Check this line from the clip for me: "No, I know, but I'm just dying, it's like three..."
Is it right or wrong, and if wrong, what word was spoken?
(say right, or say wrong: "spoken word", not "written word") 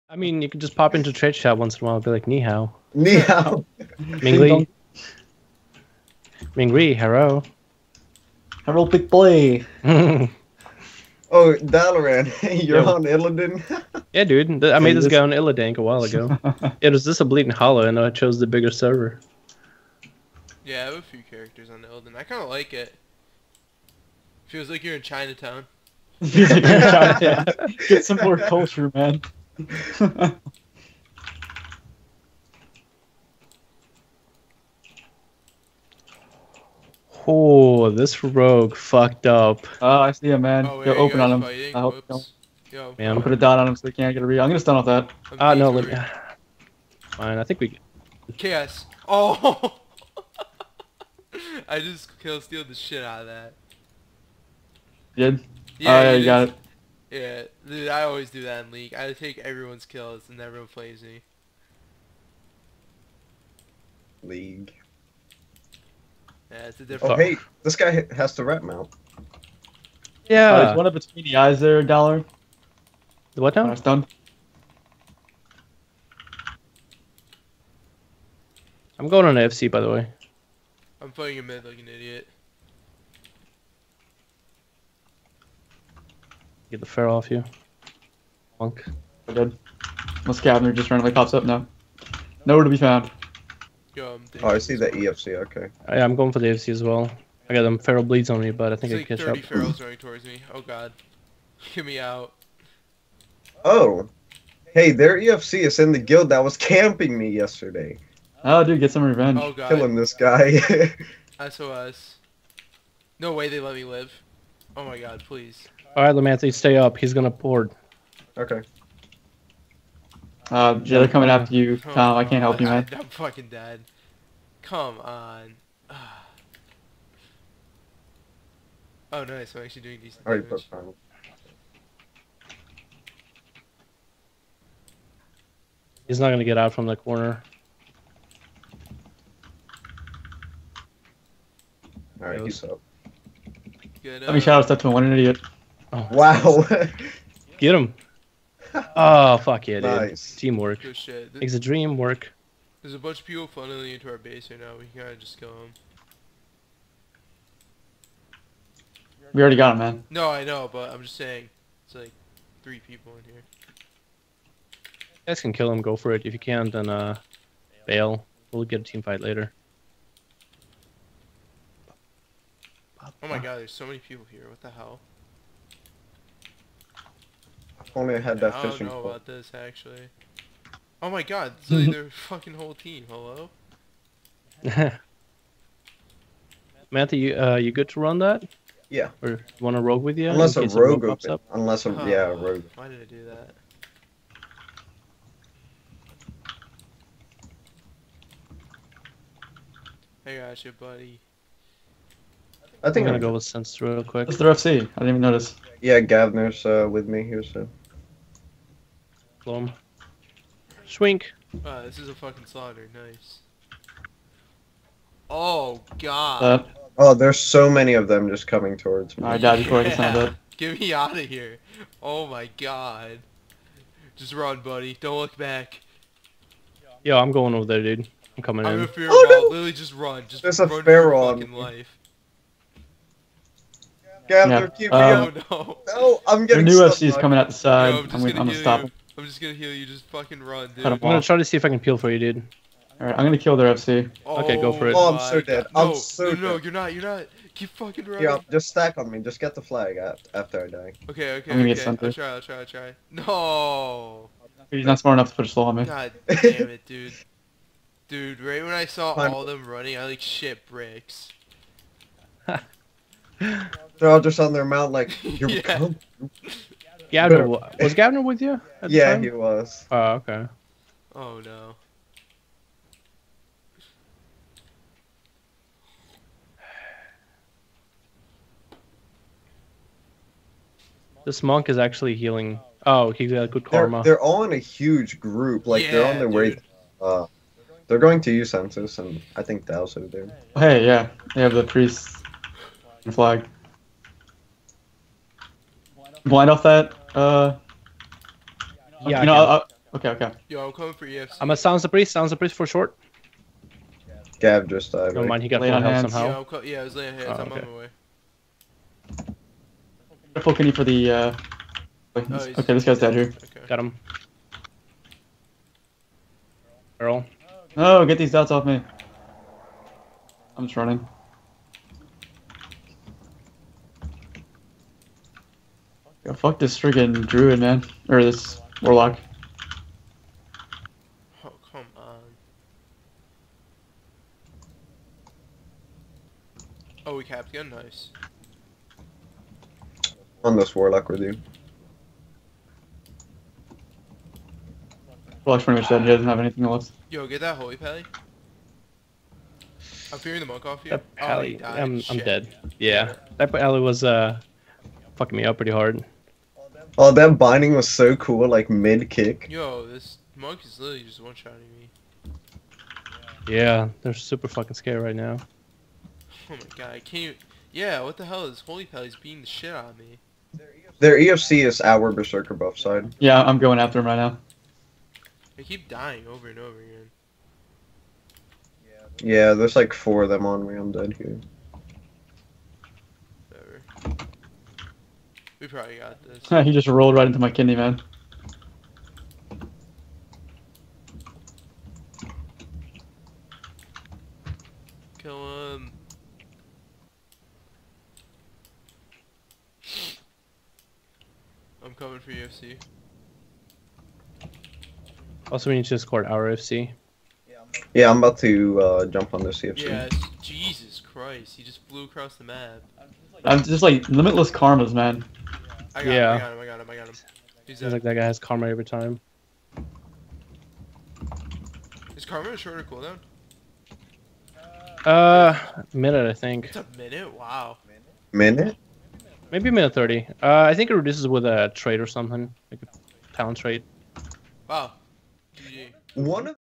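wrong: "saying", not "dying".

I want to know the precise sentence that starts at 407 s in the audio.
Yeah, I'm about to uh, jump on this EFC.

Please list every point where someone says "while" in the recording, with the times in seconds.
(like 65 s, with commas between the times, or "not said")
1 s, 15 s.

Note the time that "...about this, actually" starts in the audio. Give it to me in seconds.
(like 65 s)
179 s.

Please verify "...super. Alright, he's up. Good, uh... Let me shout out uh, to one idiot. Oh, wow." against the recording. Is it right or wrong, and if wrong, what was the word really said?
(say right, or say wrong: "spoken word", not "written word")
wrong: "corner", not "super".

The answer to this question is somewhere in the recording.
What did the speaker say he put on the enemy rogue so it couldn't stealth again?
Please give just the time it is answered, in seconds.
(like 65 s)
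43 s.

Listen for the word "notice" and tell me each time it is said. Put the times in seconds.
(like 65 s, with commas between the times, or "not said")
205 s.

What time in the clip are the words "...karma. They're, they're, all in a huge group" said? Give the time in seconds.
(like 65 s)
283 s.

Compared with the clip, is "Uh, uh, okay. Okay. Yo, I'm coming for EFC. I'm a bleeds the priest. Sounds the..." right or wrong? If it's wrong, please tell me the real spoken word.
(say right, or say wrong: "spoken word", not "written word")
wrong: "sounds", not "bleeds".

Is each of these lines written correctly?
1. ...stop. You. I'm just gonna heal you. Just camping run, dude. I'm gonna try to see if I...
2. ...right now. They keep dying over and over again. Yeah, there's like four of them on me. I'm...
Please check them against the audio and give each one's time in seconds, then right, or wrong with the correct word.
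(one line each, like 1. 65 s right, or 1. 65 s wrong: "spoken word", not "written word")
1. 238 s wrong: "fucking", not "camping"
2. 374 s right.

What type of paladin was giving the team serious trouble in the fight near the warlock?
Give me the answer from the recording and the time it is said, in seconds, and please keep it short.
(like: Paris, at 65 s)
Holy pally, at 347 s.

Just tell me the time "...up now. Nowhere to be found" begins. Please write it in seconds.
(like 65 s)
91 s.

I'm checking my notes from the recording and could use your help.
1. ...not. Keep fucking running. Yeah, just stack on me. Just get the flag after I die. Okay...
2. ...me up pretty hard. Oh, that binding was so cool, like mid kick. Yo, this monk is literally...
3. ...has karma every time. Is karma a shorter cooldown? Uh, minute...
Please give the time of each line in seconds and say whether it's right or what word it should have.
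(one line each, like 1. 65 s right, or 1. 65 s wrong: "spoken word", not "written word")
1. 247 s right
2. 355 s right
3. 418 s right.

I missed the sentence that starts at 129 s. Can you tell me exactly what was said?
I'm actually doing decent All right, damage.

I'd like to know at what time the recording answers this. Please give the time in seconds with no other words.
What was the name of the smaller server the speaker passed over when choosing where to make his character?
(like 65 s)
17 s.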